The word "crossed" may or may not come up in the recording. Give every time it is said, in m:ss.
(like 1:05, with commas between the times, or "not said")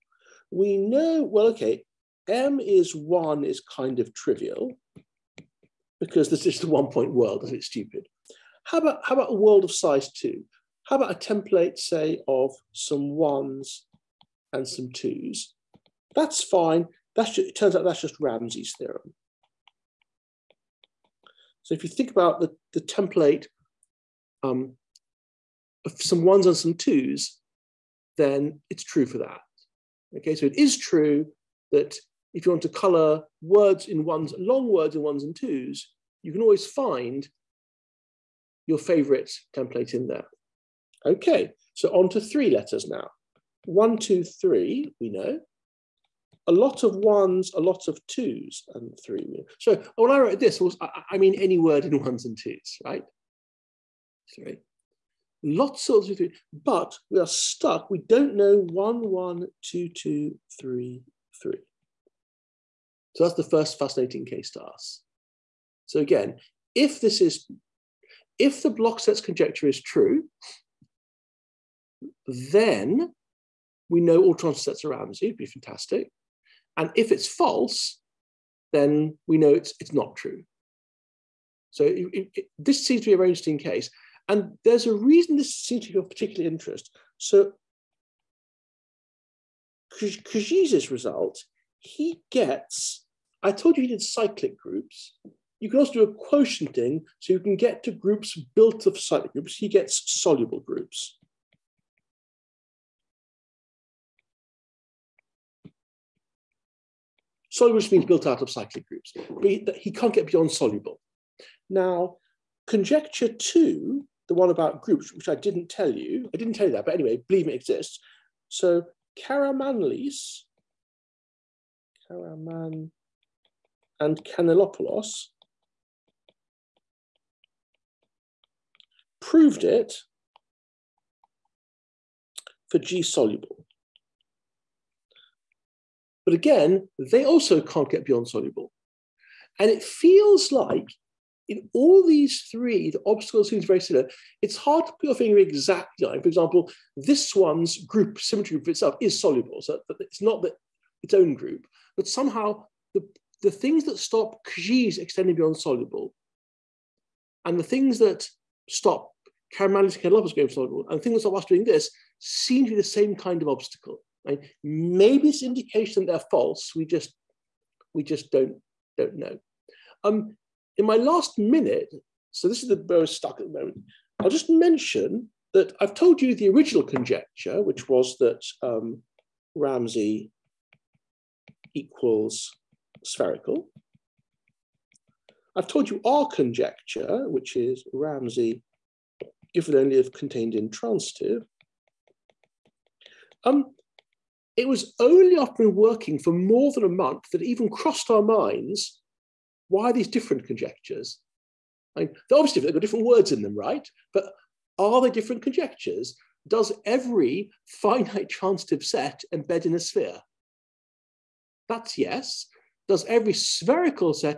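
3:17.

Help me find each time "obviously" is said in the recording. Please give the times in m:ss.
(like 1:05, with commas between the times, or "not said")
3:22.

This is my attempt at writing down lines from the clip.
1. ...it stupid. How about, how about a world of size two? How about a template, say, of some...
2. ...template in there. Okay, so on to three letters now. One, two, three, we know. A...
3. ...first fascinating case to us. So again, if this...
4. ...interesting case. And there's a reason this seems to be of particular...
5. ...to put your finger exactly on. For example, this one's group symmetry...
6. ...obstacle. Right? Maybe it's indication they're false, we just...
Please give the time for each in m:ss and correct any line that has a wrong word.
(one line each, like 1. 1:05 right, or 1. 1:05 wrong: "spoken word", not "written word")
1. 0:07 right
2. 0:39 right
3. 1:03 right
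4. 1:23 right
5. 2:24 right
6. 2:43 right.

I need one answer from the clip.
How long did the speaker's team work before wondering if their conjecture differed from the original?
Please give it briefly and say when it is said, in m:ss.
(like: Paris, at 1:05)
More than a month, at 3:16.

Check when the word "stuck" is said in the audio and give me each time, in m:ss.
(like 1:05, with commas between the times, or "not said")
0:57, 2:53.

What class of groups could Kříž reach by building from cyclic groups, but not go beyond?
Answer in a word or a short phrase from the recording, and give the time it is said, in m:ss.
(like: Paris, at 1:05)
Soluble groups, at 1:40.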